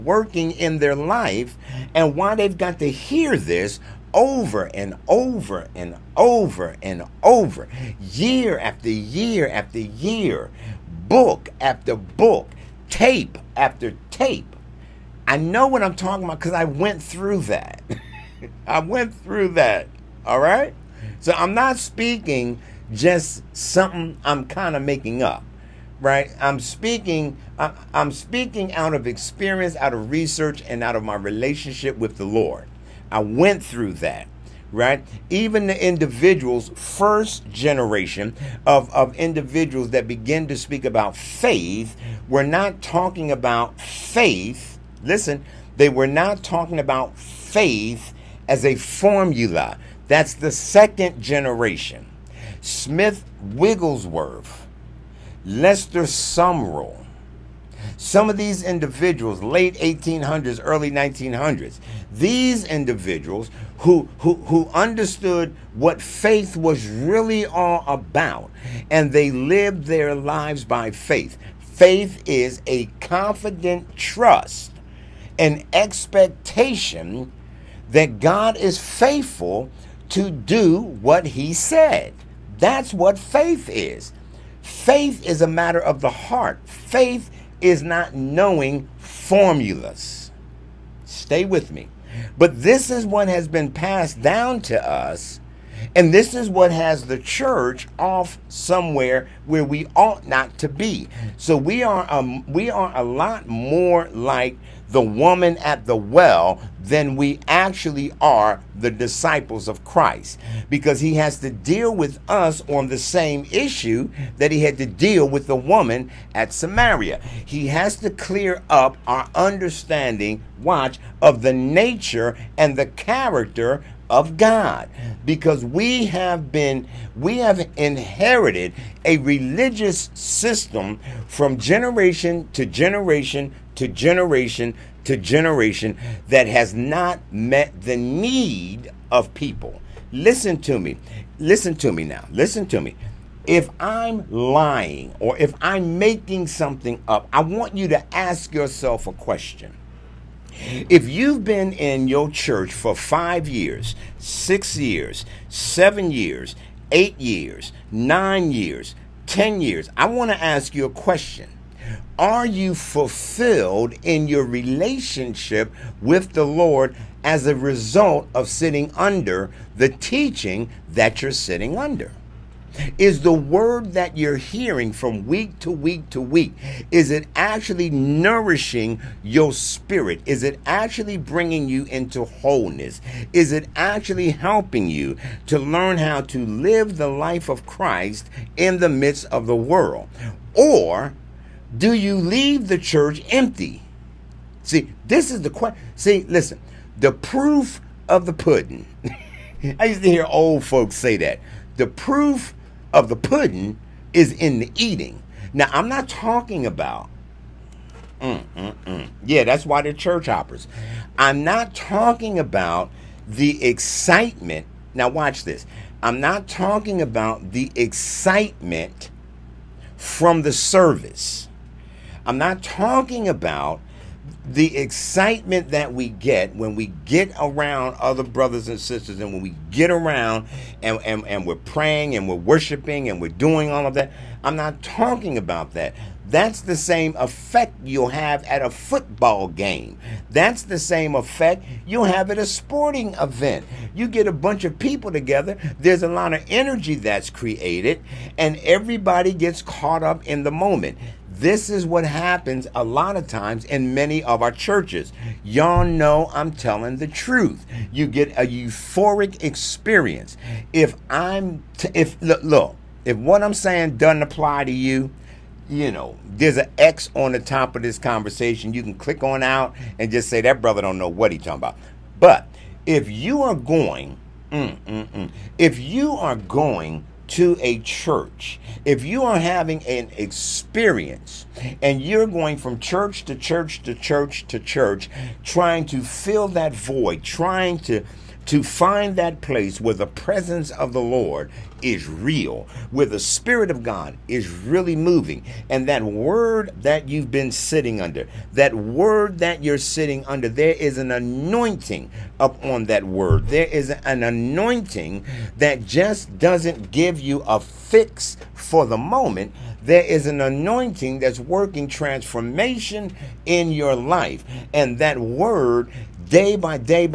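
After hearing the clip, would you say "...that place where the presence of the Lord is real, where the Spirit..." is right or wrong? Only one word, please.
right.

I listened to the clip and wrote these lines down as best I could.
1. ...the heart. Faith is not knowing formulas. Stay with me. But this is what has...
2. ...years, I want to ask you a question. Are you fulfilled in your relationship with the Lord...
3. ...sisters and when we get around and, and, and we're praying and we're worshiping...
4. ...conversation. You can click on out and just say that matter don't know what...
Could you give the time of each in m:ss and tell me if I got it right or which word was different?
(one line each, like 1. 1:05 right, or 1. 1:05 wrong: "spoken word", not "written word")
1. 1:26 right
2. 2:39 right
3. 3:48 right
4. 4:27 wrong: "brother", not "matter".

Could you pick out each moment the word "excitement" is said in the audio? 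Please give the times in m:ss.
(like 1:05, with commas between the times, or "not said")
3:33, 3:37, 3:44.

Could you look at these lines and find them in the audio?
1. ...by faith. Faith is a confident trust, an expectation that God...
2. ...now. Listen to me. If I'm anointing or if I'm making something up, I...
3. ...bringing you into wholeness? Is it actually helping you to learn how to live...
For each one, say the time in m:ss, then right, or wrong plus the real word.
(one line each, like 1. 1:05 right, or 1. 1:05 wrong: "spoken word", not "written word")
1. 1:10 right
2. 2:22 wrong: "lying", not "anointing"
3. 3:01 right.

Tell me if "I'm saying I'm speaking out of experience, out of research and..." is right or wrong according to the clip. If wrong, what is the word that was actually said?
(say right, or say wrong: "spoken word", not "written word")
wrong: "speaking", not "saying".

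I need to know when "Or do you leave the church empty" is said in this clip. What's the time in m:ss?
3:10.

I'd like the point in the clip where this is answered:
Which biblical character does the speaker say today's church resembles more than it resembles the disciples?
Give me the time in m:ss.
1:44.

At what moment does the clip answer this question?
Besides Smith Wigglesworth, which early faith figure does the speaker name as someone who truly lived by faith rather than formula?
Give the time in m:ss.
0:55.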